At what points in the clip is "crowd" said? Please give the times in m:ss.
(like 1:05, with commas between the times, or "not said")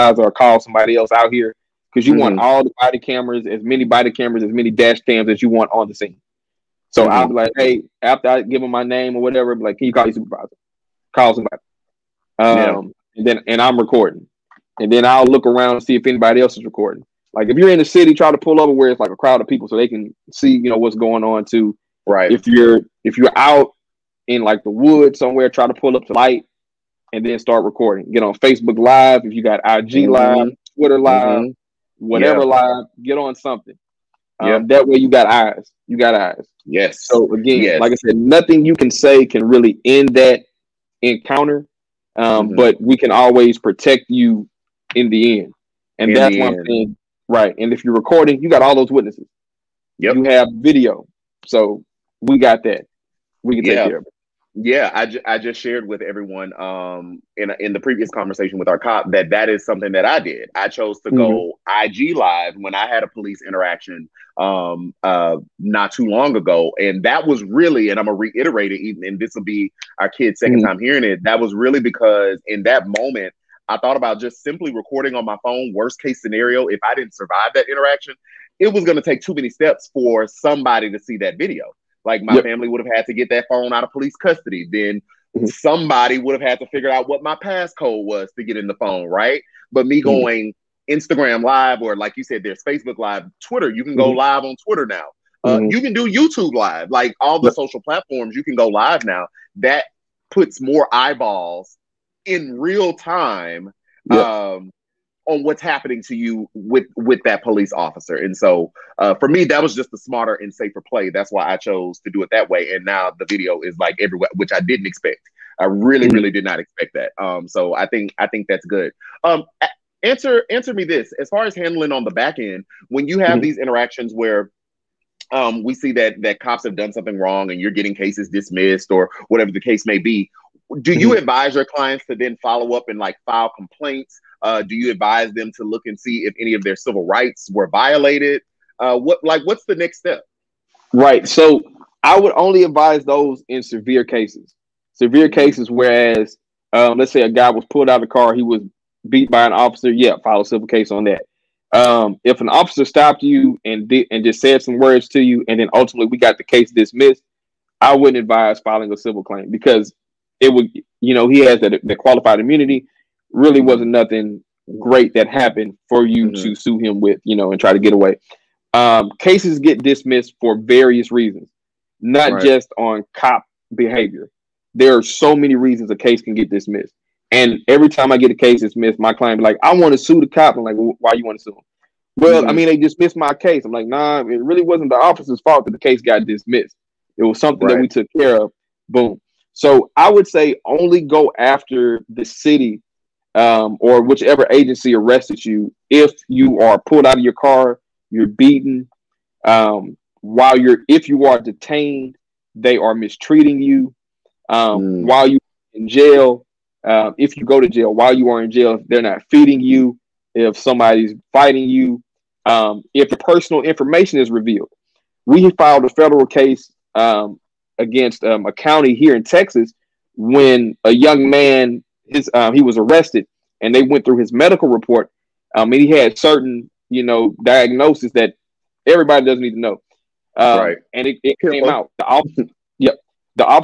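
0:19.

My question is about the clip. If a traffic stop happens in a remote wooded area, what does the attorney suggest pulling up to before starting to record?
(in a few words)
Light.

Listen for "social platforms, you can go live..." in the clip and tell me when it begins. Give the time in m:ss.
1:37.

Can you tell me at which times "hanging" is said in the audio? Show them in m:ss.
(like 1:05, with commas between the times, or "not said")
not said.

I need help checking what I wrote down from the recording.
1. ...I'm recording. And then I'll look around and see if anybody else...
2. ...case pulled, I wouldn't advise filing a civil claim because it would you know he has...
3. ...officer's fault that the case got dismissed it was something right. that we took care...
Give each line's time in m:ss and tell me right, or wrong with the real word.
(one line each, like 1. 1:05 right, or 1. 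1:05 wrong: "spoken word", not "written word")
1. 0:13 right
2. 2:36 wrong: "dismissed", not "pulled"
3. 3:04 right.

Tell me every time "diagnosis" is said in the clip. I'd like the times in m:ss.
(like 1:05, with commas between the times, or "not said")
3:47.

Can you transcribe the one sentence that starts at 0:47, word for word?
And if you're recording, you got all those witnesses.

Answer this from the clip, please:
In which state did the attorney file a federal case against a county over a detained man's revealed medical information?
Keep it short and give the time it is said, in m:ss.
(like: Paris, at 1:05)
Texas, at 3:39.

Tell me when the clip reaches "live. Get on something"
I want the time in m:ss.
0:32.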